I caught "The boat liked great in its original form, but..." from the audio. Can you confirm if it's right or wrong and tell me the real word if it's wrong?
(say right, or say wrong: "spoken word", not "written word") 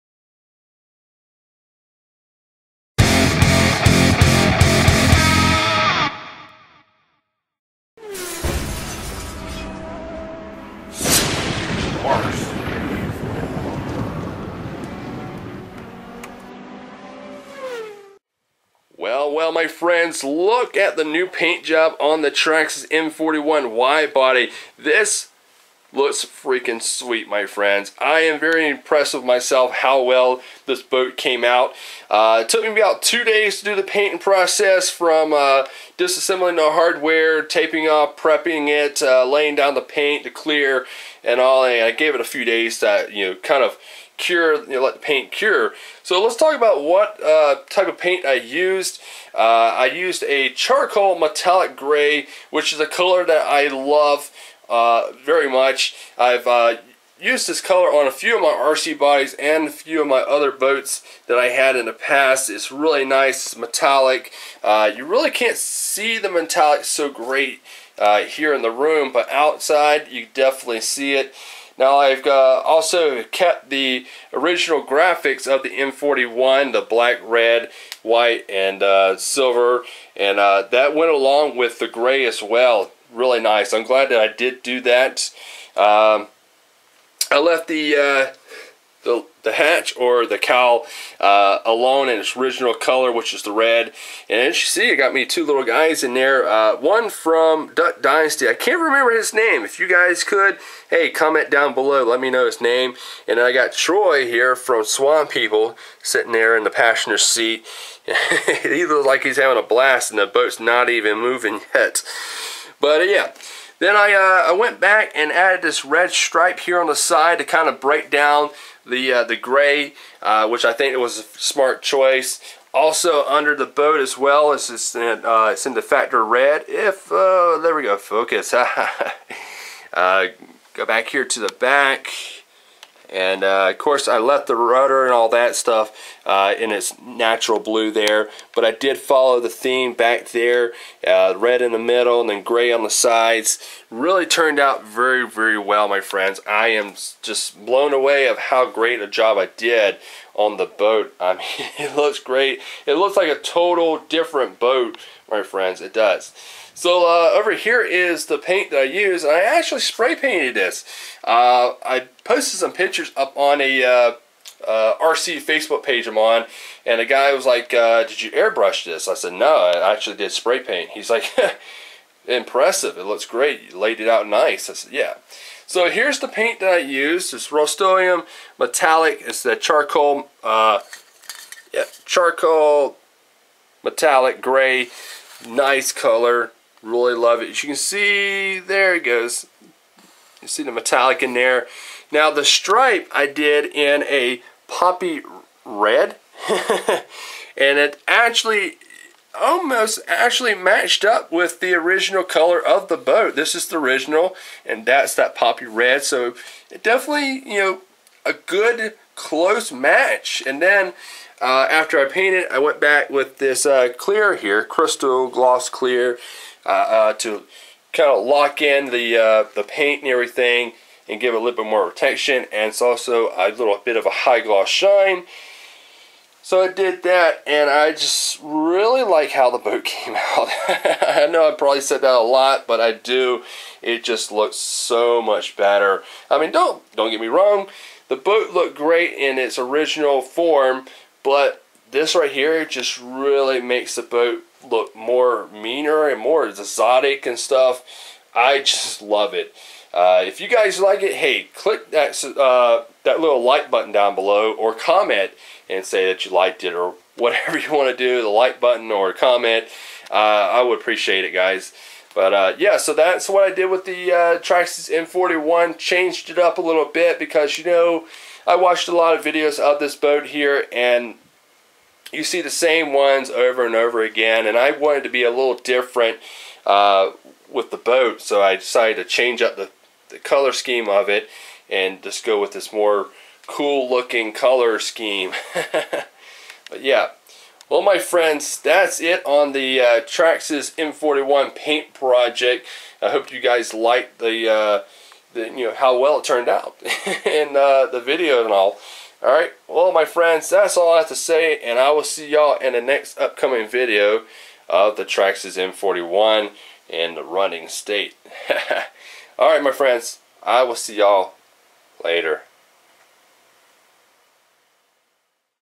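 wrong: "looked", not "liked".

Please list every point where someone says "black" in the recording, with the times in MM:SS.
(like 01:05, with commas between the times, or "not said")
01:16.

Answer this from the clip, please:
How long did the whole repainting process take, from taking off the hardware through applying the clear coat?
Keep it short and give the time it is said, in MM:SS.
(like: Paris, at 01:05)
2 days, at 00:33.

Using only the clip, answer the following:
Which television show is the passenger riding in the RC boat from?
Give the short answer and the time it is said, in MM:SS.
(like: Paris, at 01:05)
Swamp People, at 01:44.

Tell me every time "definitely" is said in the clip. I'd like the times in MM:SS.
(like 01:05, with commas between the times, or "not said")
01:10, 03:26.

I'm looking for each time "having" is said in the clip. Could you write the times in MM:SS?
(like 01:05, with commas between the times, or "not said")
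01:49.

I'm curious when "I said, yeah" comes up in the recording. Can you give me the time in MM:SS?
02:54.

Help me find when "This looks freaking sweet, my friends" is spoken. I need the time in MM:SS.
00:24.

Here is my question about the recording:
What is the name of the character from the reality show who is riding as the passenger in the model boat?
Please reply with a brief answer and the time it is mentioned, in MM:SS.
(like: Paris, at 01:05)
Troy, at 01:43.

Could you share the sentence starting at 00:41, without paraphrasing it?
And I gave it a few days to you know kind of cure, you know, let the paint cure.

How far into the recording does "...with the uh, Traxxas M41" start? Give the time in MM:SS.
04:23.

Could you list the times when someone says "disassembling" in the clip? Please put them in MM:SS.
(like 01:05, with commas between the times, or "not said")
00:35.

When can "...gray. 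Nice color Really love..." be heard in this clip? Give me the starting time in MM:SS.
03:04.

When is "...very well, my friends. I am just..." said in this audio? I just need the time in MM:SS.
02:25.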